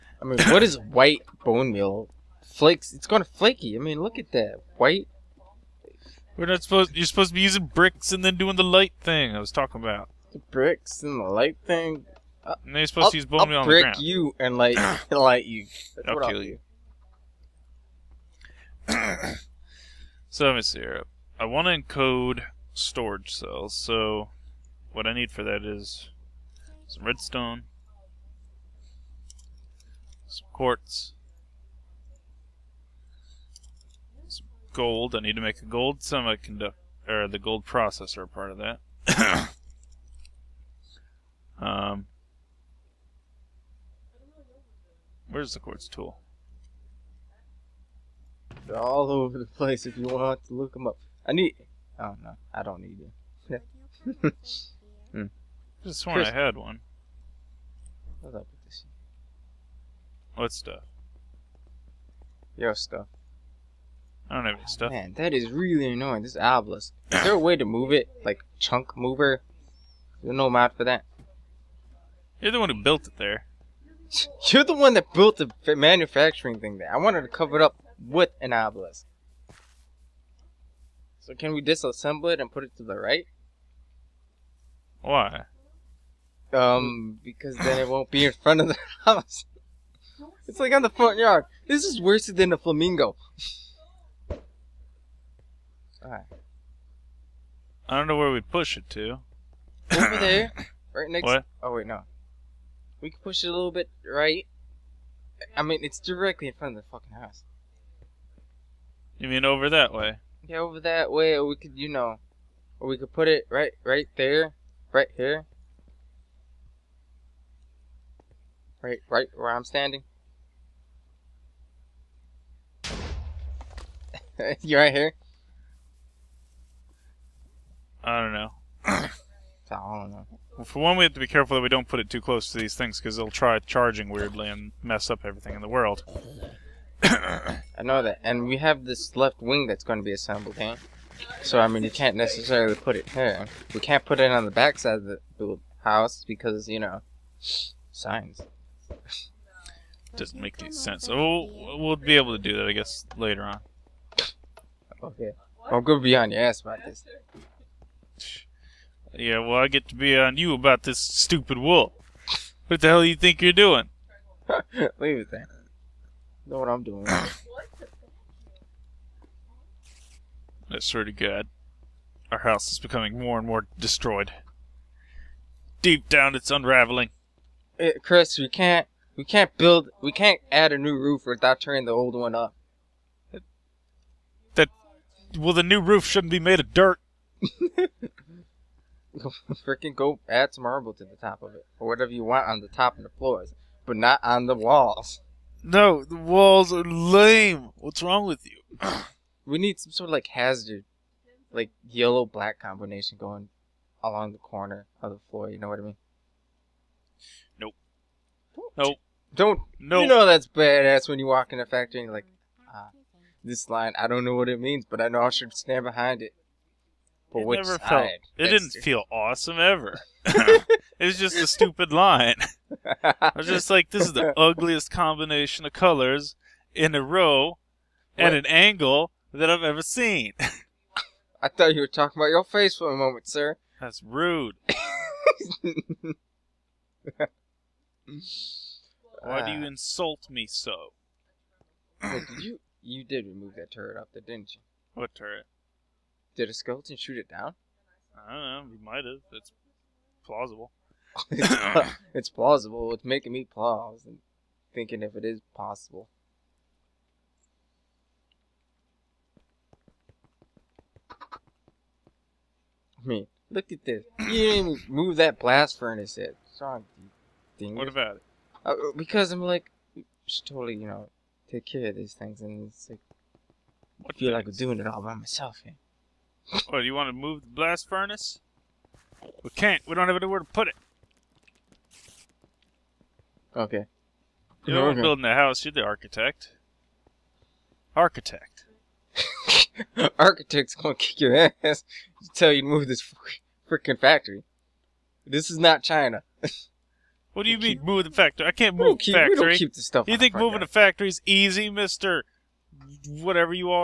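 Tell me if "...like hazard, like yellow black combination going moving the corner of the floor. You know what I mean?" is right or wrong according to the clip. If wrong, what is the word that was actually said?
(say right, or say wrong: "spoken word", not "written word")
wrong: "along", not "moving".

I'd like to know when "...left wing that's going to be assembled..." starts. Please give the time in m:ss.
2:19.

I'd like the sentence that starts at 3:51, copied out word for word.
I thought you were talking about your face for a moment, sir.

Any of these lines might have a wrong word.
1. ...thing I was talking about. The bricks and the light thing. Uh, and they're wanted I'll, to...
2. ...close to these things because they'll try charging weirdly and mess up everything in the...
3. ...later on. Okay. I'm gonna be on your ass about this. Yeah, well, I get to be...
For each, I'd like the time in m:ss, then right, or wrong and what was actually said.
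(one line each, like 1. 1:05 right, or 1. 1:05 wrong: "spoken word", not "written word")
1. 0:09 wrong: "supposed", not "wanted"
2. 2:12 right
3. 2:33 right.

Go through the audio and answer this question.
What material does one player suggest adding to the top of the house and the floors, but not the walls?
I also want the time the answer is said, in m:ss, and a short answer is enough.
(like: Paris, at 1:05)
Marble, at 3:10.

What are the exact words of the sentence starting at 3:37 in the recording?
Felt, it That's didn't feel awesome ever.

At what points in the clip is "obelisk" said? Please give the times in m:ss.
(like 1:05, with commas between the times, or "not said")
1:06, 1:18.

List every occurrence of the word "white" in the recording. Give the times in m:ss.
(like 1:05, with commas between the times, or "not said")
0:00, 0:04.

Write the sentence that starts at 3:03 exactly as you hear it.
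That, that well, the new roof shouldn't be made of dirt.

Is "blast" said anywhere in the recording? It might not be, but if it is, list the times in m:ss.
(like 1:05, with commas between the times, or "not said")
4:25, 4:37.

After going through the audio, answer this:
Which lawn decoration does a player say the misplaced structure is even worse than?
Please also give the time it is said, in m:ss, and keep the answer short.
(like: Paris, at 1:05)
A flamingo, at 1:32.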